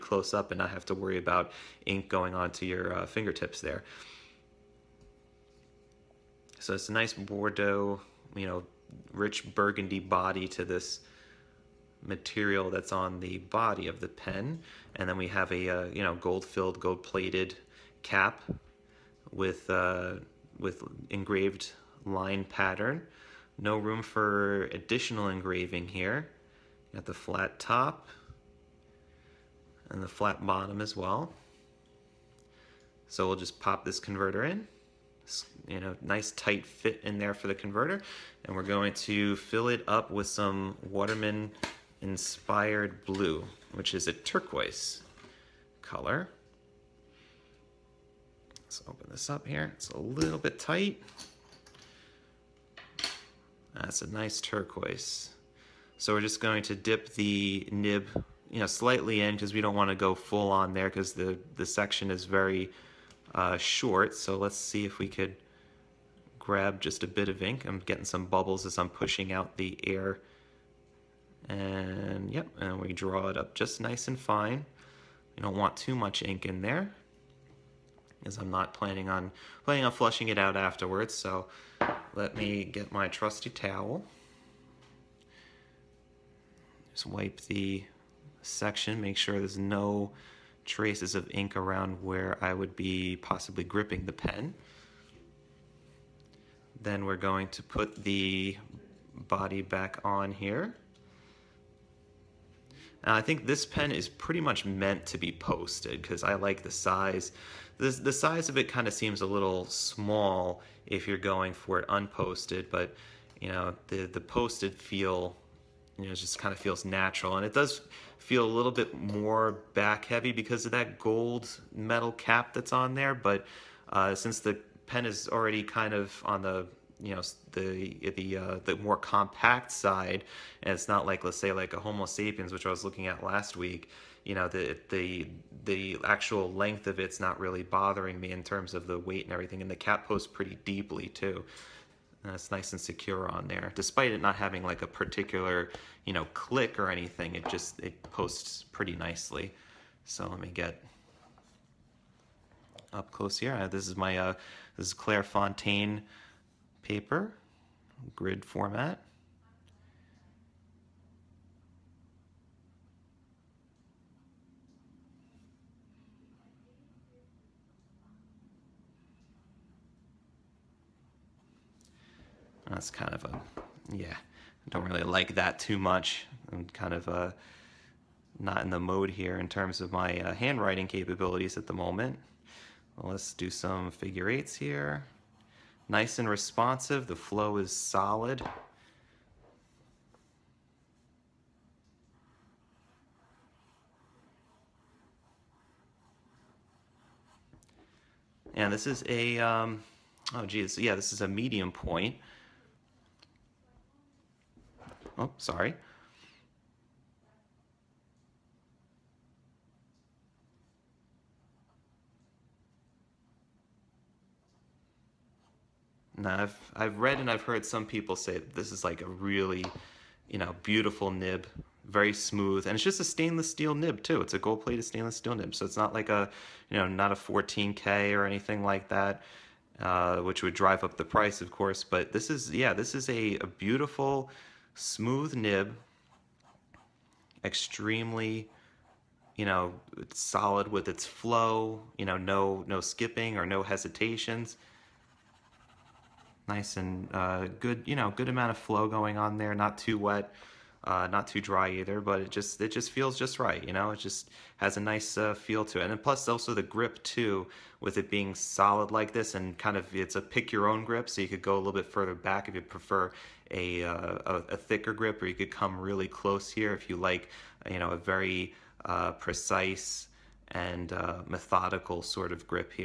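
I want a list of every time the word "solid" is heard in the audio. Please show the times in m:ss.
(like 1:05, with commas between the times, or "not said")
3:07, 4:00, 4:18.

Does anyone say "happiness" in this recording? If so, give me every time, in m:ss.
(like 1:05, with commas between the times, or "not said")
not said.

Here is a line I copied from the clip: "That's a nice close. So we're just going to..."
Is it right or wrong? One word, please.
wrong.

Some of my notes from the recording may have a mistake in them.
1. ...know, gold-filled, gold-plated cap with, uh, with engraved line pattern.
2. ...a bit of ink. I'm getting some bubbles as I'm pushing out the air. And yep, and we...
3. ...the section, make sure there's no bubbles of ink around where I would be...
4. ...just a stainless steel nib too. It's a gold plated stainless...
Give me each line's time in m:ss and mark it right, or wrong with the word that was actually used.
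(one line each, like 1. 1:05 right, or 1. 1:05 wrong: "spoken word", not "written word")
1. 0:16 right
2. 1:07 right
3. 1:27 wrong: "traces", not "bubbles"
4. 3:42 right.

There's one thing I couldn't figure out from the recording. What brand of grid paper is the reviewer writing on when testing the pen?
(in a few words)
Clairefontaine.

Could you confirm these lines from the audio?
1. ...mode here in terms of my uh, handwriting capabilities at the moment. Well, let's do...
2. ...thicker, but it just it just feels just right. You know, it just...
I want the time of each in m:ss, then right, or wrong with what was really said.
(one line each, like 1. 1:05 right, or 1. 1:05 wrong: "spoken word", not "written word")
1. 2:58 right
2. 4:11 wrong: "either", not "thicker".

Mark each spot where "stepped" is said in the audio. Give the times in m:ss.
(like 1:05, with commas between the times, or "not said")
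not said.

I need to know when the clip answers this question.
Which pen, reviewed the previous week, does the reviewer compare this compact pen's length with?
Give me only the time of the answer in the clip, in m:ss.
2:11.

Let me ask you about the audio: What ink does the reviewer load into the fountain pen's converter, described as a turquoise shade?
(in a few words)
Waterman inspired blue.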